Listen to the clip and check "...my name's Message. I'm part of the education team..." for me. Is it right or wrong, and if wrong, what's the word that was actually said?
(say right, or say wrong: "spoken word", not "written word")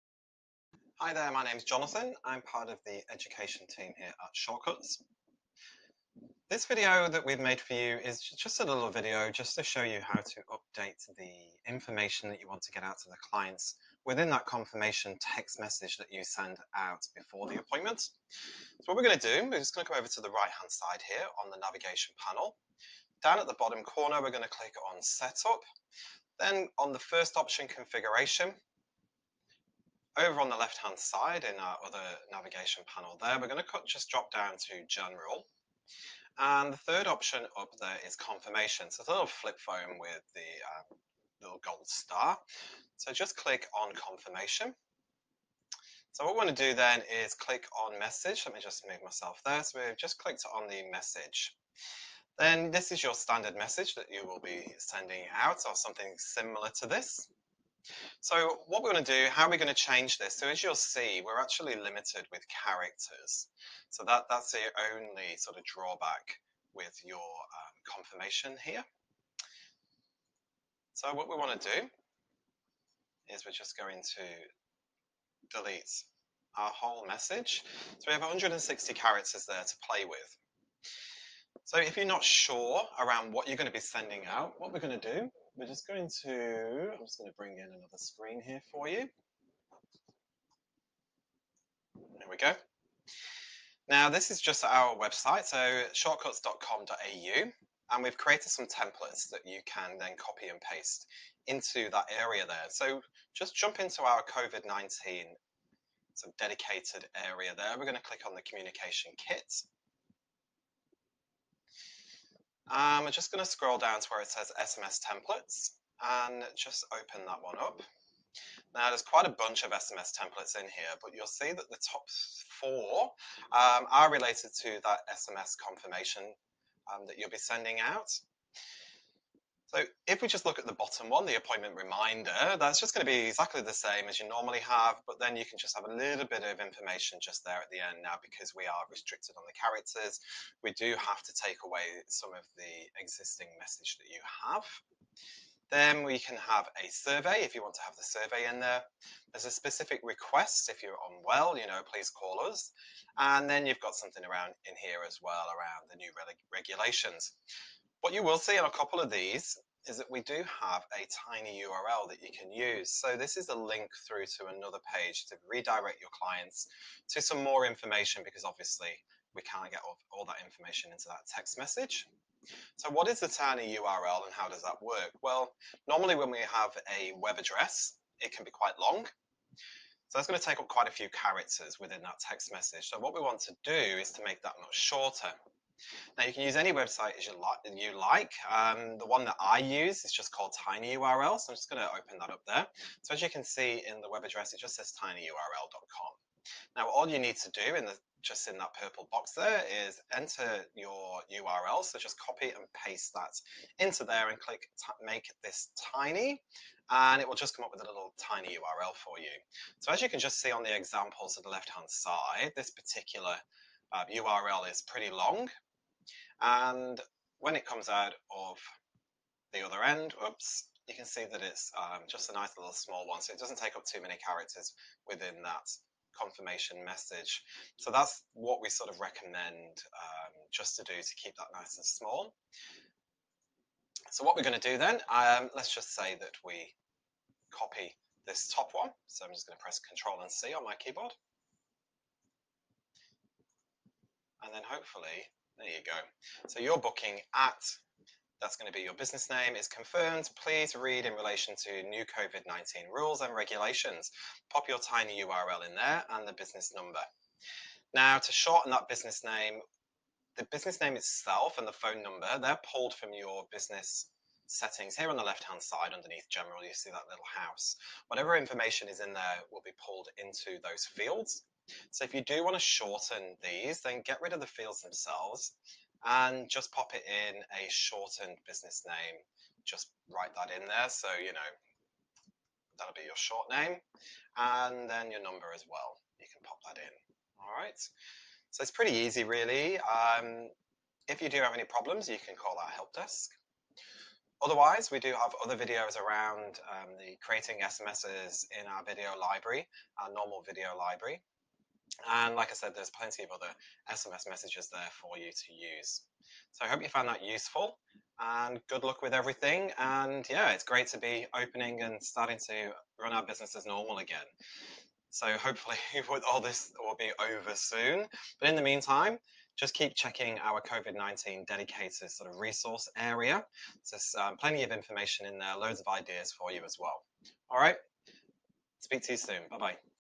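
wrong: "Jonathan", not "Message".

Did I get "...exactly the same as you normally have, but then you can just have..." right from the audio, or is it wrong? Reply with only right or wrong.
right.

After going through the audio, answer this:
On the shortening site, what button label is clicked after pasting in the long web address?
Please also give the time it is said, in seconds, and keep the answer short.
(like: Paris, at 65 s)
Make this tiny, at 205 s.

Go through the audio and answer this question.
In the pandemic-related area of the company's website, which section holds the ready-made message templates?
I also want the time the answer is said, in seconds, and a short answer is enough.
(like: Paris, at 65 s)
Communication kit, at 108 s.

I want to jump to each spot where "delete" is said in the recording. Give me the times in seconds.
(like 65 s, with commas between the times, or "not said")
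75 s.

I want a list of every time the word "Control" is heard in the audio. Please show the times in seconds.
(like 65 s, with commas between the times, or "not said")
239 s.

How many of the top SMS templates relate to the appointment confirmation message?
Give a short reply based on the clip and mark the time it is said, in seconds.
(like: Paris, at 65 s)
4, at 122 s.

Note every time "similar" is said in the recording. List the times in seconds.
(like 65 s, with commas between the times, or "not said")
56 s.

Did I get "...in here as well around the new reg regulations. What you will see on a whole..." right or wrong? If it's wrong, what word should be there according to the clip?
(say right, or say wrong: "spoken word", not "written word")
wrong: "couple", not "whole".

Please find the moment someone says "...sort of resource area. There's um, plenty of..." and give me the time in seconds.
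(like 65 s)
322 s.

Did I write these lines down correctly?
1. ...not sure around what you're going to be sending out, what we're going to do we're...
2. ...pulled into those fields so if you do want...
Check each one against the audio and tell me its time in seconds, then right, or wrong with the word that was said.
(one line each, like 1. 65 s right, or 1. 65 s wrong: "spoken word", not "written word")
1. 82 s right
2. 269 s right.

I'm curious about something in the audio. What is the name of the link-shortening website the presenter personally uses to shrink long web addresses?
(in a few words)
tinyurl.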